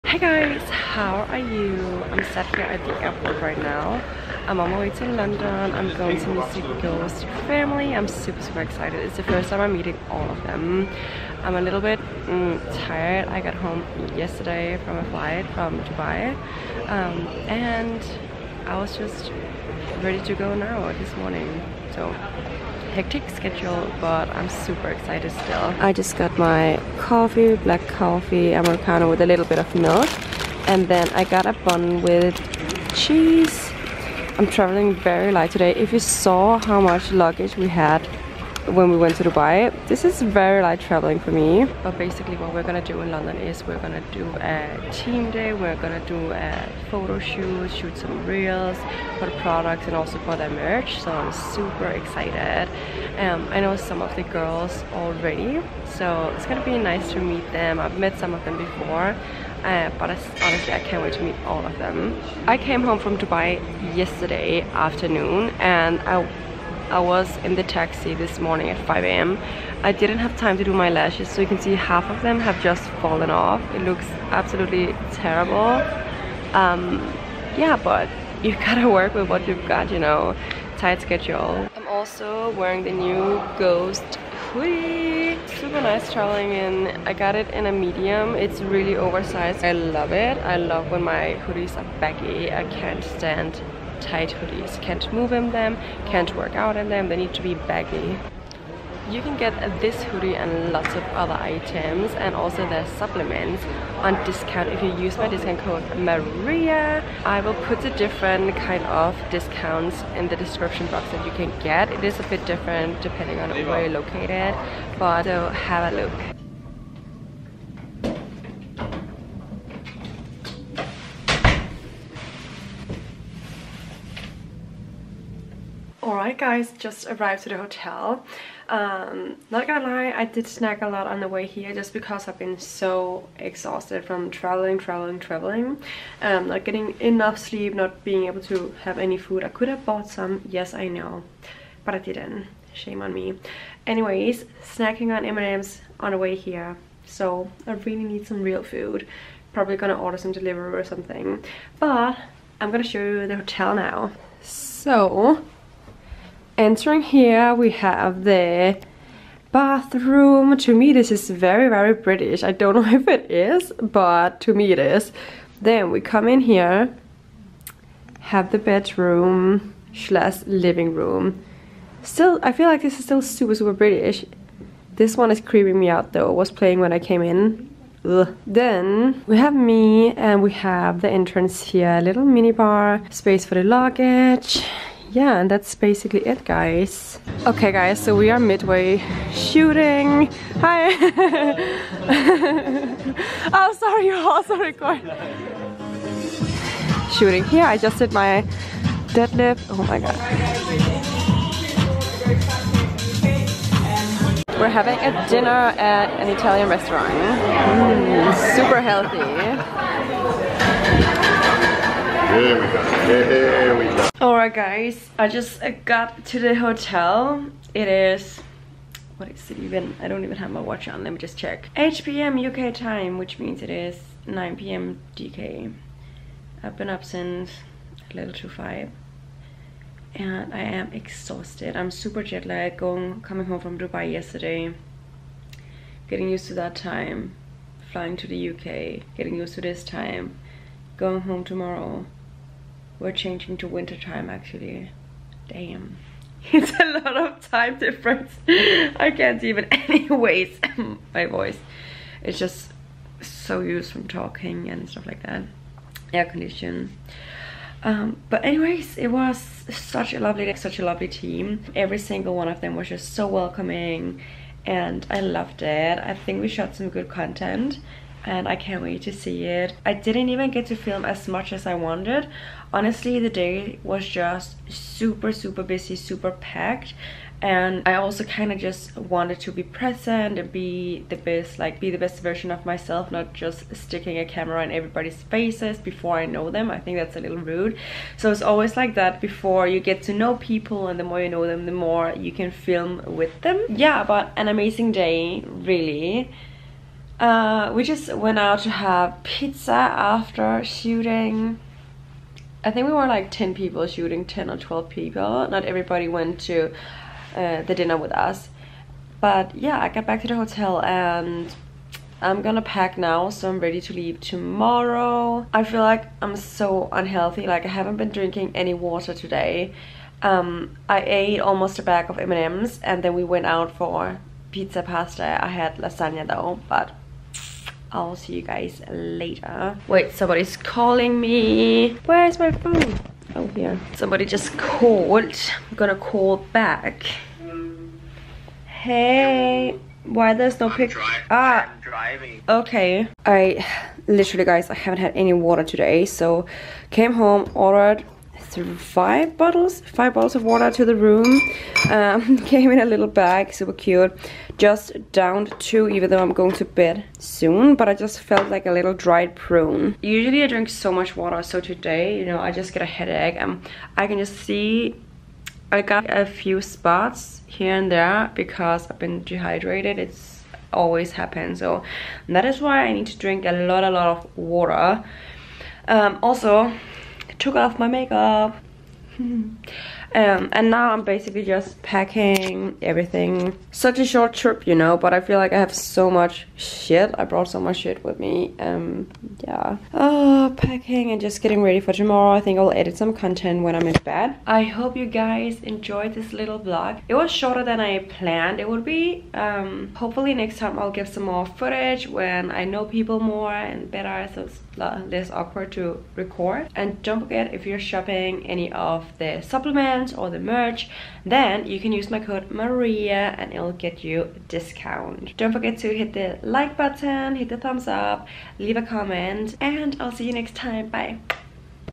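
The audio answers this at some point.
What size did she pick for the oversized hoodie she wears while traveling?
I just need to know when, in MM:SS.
01:27.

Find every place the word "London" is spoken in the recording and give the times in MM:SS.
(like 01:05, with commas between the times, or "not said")
00:05, 00:43.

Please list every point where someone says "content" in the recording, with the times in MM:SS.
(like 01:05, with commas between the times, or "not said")
04:27, 06:33.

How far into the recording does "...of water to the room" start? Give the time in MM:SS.
05:50.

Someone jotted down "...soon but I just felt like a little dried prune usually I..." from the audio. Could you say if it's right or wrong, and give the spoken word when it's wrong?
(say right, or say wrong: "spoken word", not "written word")
right.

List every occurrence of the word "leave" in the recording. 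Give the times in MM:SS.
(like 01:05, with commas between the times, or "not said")
05:13, 06:58.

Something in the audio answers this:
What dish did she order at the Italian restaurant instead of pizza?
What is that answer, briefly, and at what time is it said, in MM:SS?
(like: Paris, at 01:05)
Lasagna, at 05:25.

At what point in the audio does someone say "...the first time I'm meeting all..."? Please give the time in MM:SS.
00:09.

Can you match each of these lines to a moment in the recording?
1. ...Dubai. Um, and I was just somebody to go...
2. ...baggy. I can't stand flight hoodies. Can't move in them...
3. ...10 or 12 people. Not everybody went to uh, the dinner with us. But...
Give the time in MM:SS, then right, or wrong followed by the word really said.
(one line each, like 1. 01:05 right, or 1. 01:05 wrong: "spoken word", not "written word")
1. 00:15 wrong: "ready", not "somebody"
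2. 01:32 wrong: "tight", not "flight"
3. 05:04 right.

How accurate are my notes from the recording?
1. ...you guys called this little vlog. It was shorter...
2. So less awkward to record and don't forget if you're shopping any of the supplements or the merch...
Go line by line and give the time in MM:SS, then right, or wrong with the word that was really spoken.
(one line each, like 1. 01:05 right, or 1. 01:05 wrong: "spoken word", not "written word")
1. 06:34 wrong: "enjoyed", not "called"
2. 06:44 right.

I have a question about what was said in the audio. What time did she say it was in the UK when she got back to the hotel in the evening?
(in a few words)
8 p.m.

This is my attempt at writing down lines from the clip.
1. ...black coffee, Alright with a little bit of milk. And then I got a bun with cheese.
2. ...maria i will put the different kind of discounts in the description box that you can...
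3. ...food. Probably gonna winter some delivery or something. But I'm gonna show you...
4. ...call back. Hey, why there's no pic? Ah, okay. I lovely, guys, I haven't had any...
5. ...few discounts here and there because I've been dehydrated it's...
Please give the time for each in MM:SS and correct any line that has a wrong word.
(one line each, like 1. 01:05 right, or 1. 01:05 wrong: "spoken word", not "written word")
1. 00:27 wrong: "Americano", not "Alright"
2. 01:45 right
3. 02:28 wrong: "order", not "winter"
4. 05:35 wrong: "literally", not "lovely"
5. 06:06 wrong: "spots", not "discounts".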